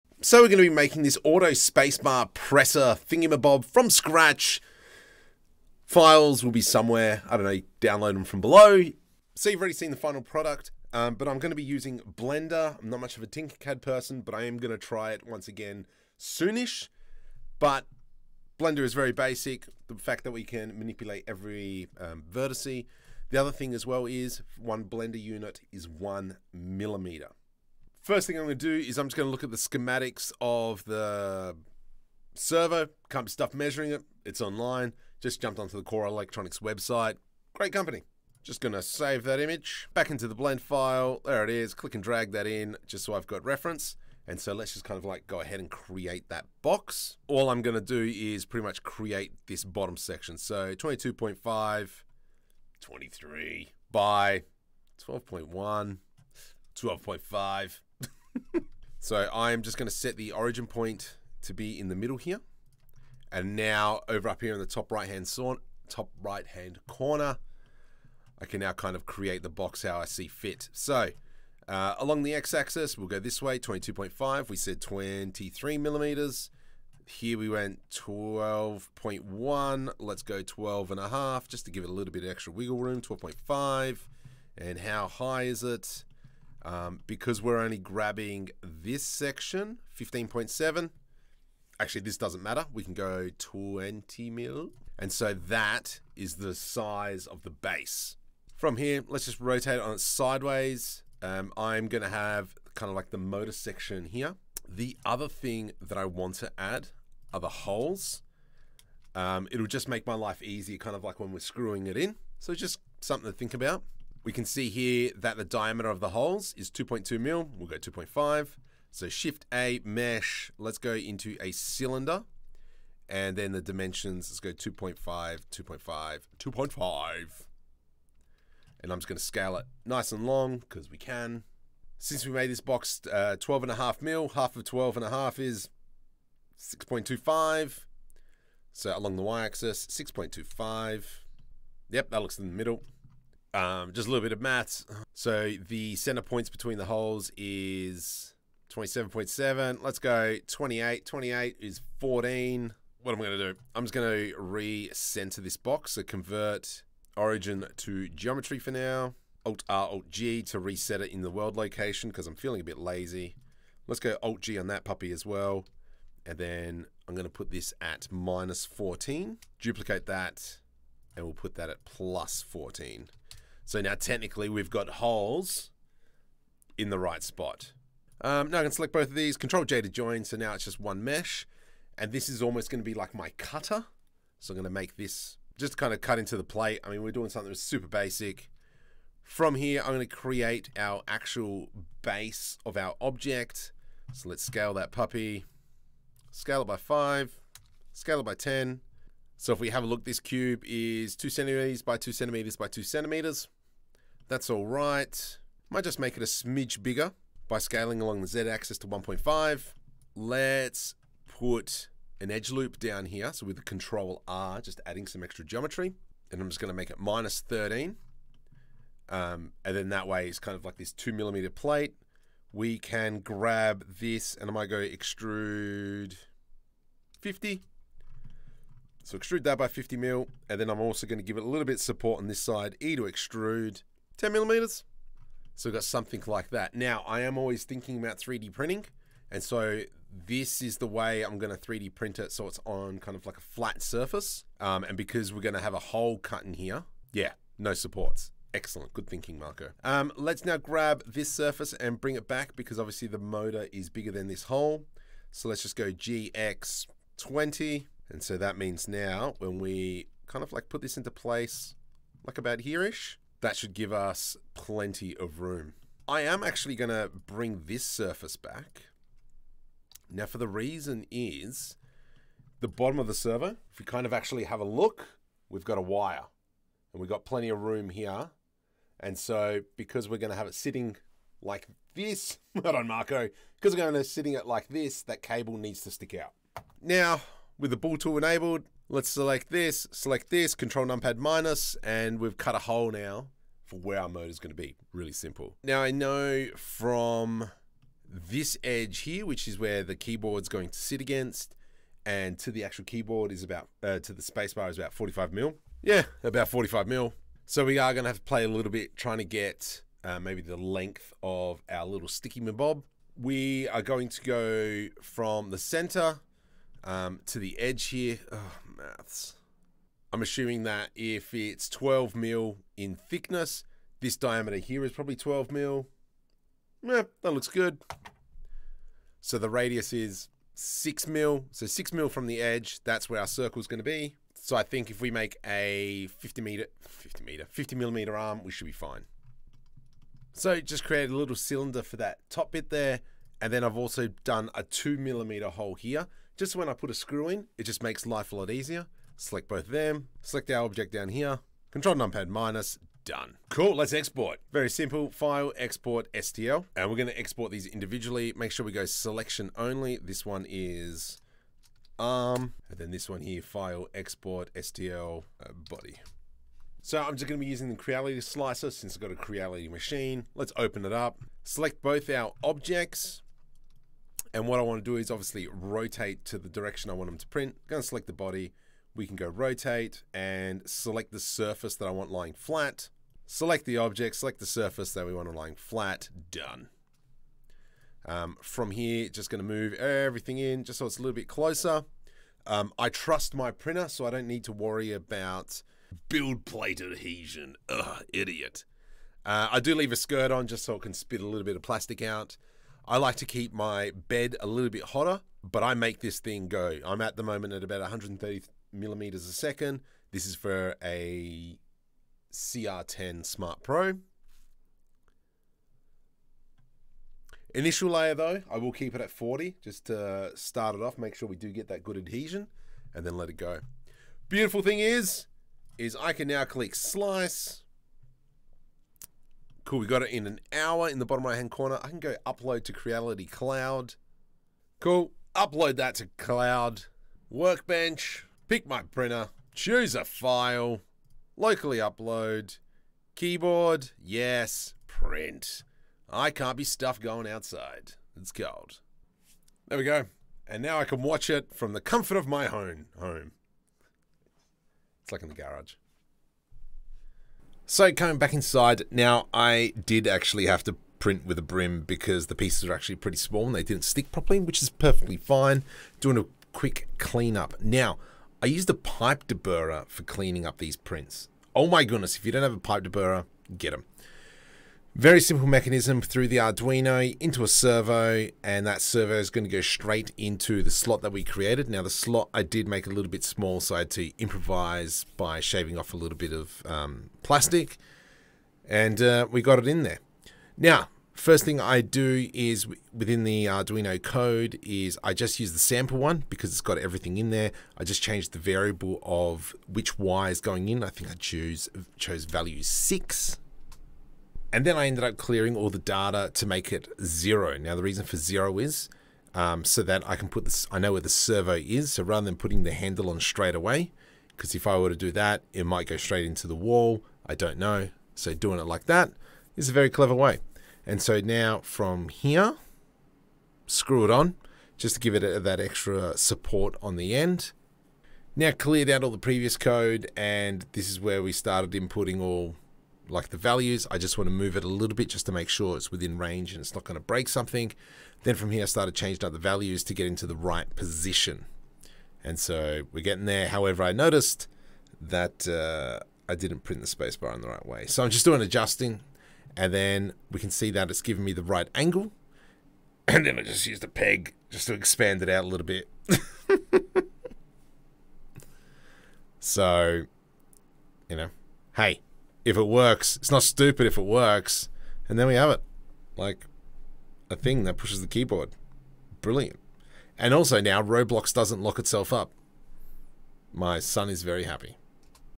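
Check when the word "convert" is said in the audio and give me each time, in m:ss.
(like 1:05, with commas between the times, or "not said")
2:36.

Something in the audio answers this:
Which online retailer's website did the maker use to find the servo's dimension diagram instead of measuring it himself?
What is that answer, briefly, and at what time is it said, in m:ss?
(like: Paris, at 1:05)
Core Electronics, at 0:35.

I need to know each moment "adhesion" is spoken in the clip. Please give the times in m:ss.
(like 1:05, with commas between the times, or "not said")
6:36, 7:01.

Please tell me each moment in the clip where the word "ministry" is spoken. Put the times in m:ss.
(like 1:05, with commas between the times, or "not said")
not said.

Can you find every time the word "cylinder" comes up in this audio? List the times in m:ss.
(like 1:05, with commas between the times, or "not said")
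2:01, 5:41.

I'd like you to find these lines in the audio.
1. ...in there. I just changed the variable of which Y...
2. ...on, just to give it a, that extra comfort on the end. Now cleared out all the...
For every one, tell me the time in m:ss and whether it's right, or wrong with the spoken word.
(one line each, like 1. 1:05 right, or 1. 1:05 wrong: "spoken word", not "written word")
1. 8:17 right
2. 8:44 wrong: "support", not "comfort".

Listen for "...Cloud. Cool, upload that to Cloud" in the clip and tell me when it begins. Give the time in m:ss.
7:13.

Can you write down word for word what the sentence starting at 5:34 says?
So I think if we make a 50 meter, 50 meter, 50 millimeter arm, we should be fine.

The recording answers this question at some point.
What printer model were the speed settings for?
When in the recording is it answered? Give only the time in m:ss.
6:52.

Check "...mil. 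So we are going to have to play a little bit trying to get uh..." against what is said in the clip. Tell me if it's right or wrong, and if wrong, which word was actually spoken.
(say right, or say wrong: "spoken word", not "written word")
right.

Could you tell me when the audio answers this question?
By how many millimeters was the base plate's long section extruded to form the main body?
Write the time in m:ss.
3:49.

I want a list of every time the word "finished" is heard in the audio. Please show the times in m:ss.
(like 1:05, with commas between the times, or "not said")
not said.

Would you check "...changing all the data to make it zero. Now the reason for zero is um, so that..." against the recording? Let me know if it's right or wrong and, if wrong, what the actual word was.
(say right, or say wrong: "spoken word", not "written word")
wrong: "clearing", not "changing".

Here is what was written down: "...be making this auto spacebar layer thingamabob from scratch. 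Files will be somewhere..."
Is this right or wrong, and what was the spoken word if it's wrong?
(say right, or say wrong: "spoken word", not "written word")
wrong: "presser", not "layer".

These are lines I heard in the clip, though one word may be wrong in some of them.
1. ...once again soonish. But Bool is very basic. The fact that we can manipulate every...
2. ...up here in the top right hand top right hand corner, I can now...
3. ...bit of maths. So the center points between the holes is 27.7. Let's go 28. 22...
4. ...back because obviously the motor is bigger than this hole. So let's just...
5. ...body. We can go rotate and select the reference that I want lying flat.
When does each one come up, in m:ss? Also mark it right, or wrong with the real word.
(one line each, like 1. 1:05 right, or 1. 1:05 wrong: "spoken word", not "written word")
1. 0:15 wrong: "Blender", not "Bool"
2. 1:04 right
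3. 2:24 wrong: "28", not "22"
4. 4:12 right
5. 6:18 wrong: "surface", not "reference".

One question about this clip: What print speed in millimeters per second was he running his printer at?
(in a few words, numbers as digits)
130.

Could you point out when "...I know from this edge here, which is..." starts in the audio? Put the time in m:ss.
4:55.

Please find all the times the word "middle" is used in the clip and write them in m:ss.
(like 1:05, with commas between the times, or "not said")
1:01, 2:22.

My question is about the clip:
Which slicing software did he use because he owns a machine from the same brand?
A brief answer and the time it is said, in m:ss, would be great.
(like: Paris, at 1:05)
Creality slicer, at 6:07.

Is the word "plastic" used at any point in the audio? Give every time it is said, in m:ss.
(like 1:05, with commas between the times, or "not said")
6:41, 8:07.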